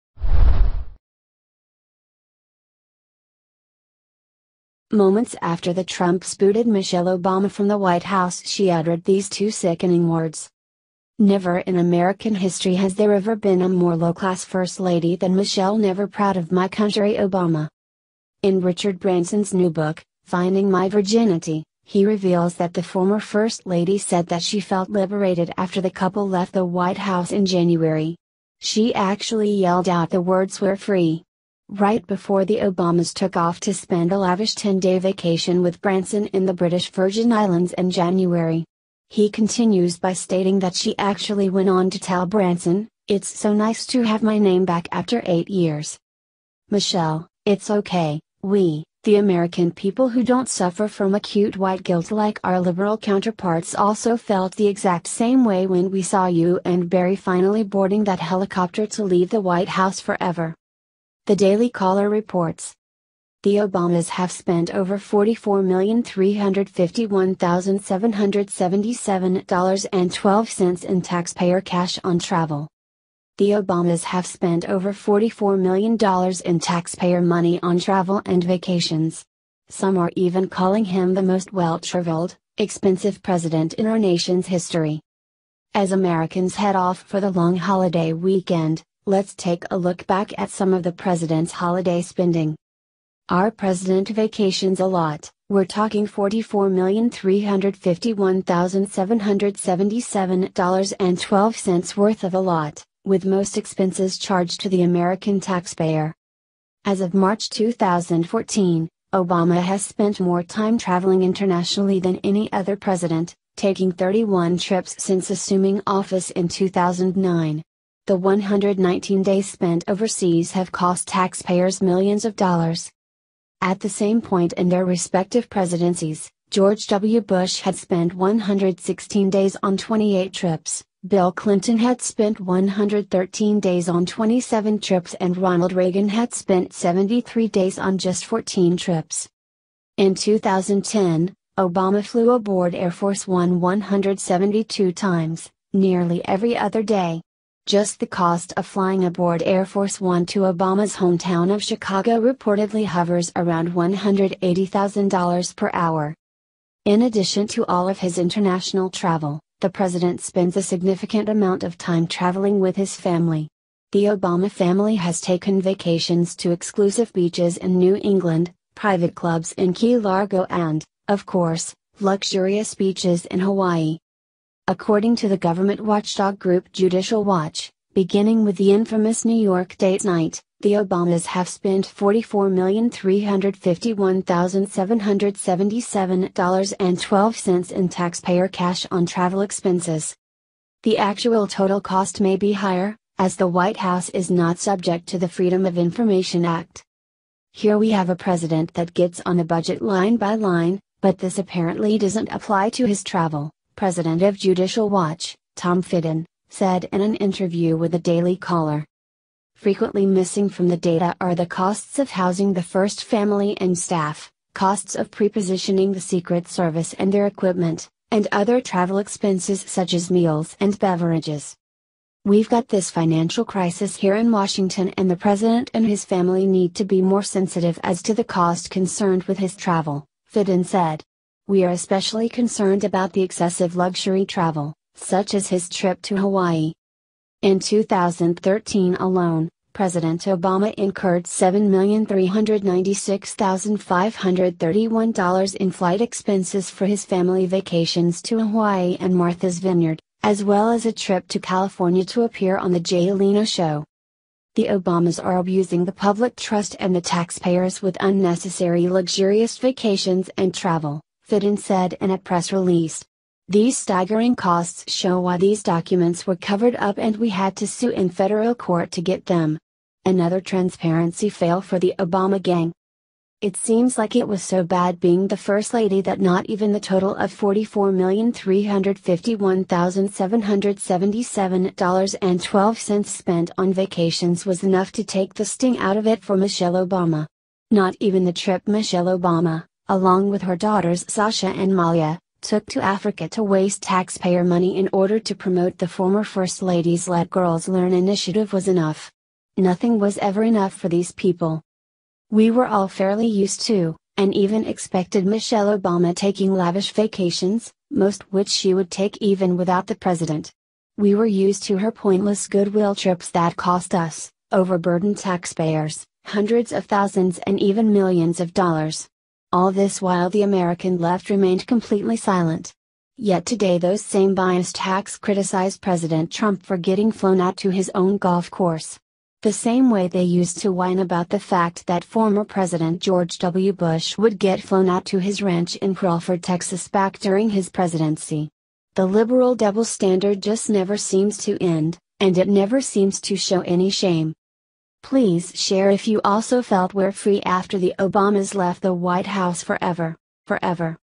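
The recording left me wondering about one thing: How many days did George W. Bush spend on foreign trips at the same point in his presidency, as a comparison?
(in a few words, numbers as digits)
116.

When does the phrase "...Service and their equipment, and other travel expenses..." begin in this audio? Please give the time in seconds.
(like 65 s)
216 s.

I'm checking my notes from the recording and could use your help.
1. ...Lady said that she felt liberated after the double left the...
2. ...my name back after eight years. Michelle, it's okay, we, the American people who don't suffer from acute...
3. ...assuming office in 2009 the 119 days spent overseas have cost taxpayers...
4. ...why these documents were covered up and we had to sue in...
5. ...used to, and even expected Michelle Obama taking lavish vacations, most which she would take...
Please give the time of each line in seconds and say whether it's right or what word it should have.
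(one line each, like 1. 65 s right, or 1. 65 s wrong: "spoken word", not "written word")
1. 23 s wrong: "couple", not "double"
2. 44 s right
3. 115 s right
4. 265 s right
5. 303 s right.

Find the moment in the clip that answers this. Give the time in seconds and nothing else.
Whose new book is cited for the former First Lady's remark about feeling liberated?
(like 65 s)
18 s.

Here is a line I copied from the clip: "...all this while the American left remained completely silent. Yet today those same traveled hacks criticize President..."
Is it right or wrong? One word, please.
wrong.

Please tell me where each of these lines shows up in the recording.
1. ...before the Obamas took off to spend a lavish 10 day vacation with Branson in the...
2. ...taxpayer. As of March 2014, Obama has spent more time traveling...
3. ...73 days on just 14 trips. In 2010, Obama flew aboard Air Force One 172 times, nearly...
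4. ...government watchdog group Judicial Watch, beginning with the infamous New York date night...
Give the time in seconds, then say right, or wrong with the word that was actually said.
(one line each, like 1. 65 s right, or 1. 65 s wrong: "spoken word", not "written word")
1. 32 s right
2. 105 s right
3. 136 s right
4. 175 s right.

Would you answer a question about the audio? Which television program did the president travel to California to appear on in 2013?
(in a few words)
The Jay Leno Show.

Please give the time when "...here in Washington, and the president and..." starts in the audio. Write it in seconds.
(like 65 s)
223 s.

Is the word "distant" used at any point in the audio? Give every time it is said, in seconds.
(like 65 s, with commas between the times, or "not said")
not said.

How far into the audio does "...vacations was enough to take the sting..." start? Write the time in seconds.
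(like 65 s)
283 s.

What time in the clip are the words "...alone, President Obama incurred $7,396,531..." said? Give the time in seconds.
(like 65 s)
238 s.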